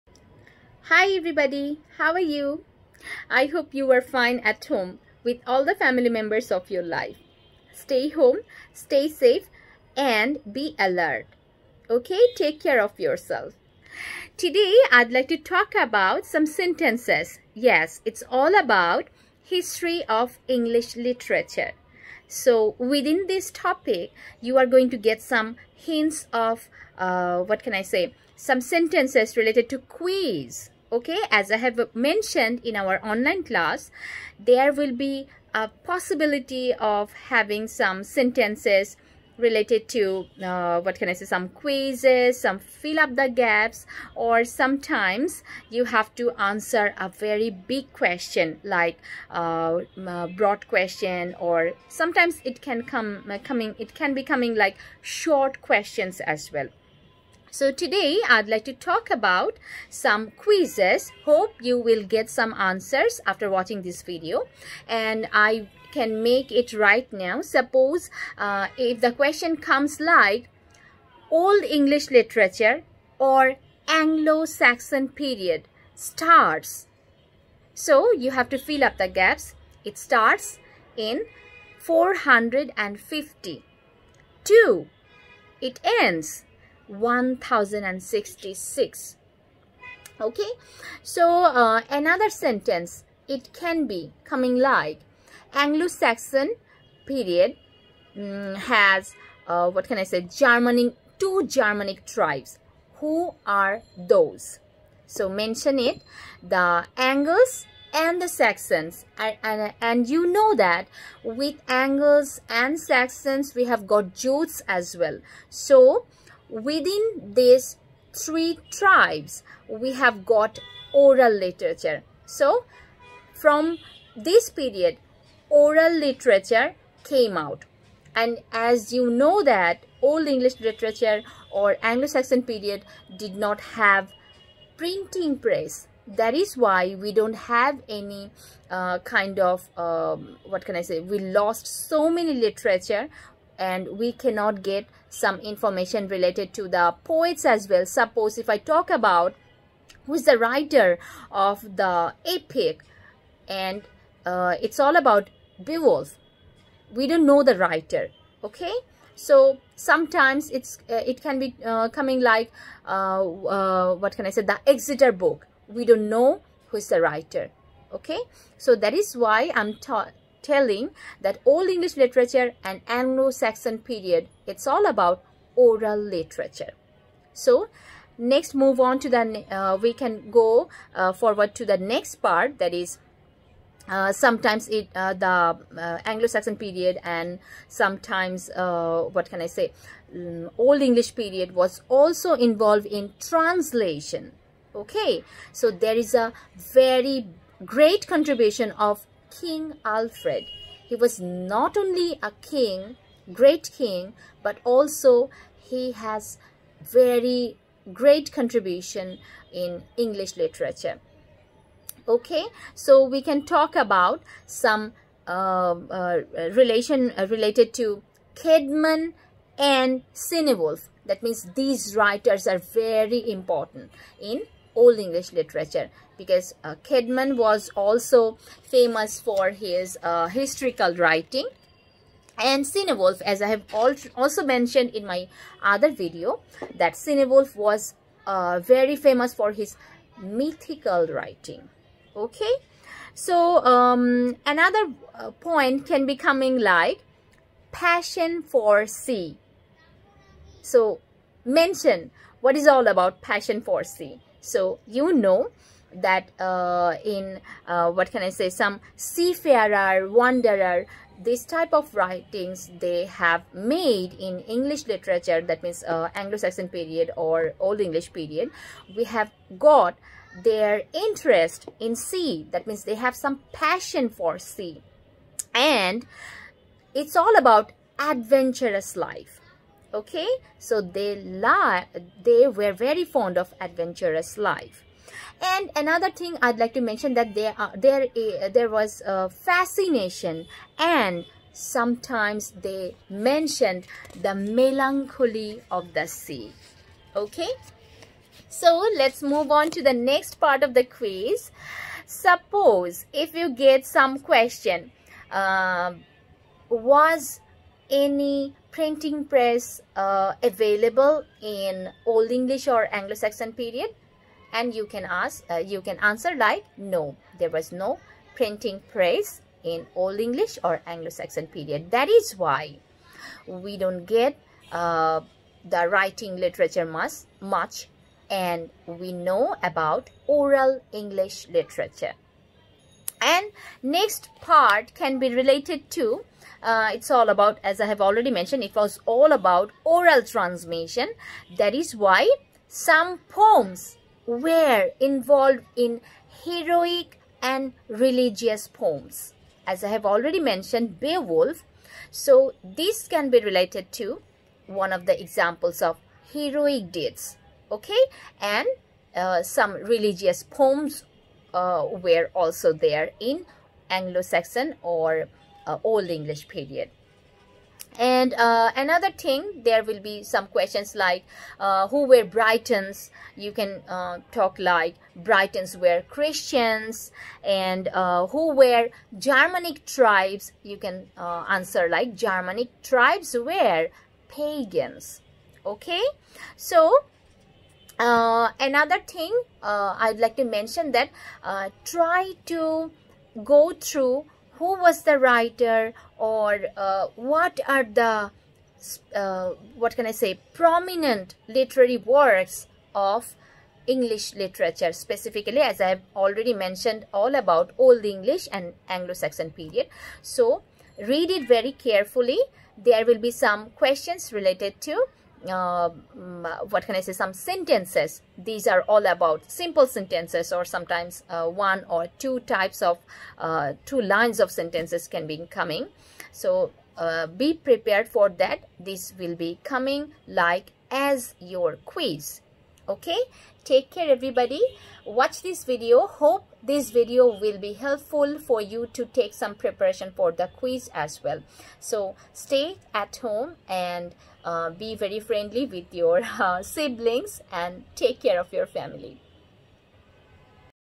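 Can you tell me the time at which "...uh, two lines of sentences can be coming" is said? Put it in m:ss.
7:03.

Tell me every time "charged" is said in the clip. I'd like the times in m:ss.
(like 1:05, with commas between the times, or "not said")
not said.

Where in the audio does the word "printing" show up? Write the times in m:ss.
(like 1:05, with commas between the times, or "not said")
2:14, 5:08, 5:18.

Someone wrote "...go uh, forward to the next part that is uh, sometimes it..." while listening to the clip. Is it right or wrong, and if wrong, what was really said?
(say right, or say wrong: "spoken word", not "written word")
right.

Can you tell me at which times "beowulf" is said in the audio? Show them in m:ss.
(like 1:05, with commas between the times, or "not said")
2:35, 5:50.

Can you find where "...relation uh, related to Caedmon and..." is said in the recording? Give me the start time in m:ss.
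3:36.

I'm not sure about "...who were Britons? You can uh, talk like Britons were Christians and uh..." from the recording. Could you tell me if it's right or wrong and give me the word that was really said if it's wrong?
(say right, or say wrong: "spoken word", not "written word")
right.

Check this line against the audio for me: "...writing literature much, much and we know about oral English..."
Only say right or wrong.
right.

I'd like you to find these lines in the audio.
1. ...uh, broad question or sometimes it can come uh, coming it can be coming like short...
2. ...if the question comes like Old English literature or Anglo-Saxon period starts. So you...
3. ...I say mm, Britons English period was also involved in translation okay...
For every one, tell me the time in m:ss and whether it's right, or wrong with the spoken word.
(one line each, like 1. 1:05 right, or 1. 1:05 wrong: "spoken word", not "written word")
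1. 0:49 right
2. 1:08 right
3. 3:09 wrong: "Old", not "Britons".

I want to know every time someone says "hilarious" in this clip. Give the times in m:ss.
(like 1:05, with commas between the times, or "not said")
not said.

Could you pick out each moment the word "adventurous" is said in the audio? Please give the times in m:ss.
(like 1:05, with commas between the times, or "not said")
4:37, 4:43.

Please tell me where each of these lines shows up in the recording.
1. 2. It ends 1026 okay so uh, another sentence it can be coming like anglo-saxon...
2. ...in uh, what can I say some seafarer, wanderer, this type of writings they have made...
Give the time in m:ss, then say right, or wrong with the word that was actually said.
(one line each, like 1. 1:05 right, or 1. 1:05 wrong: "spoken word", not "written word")
1. 1:24 wrong: "1066", not "1026"
2. 4:17 right.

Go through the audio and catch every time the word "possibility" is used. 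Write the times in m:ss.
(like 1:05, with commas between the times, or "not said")
0:35.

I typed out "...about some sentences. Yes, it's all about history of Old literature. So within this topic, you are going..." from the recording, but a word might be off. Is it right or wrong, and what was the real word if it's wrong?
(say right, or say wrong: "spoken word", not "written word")
wrong: "English", not "Old".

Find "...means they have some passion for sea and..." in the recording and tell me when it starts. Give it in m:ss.
4:32.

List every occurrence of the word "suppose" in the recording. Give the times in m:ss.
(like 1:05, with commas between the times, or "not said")
1:07, 2:27, 5:02.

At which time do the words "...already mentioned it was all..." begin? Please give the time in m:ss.
5:38.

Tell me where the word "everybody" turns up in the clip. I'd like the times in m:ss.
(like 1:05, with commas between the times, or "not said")
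0:01, 7:14.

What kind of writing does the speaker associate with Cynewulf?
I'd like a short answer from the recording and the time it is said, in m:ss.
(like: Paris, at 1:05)
Mythical writing, at 4:00.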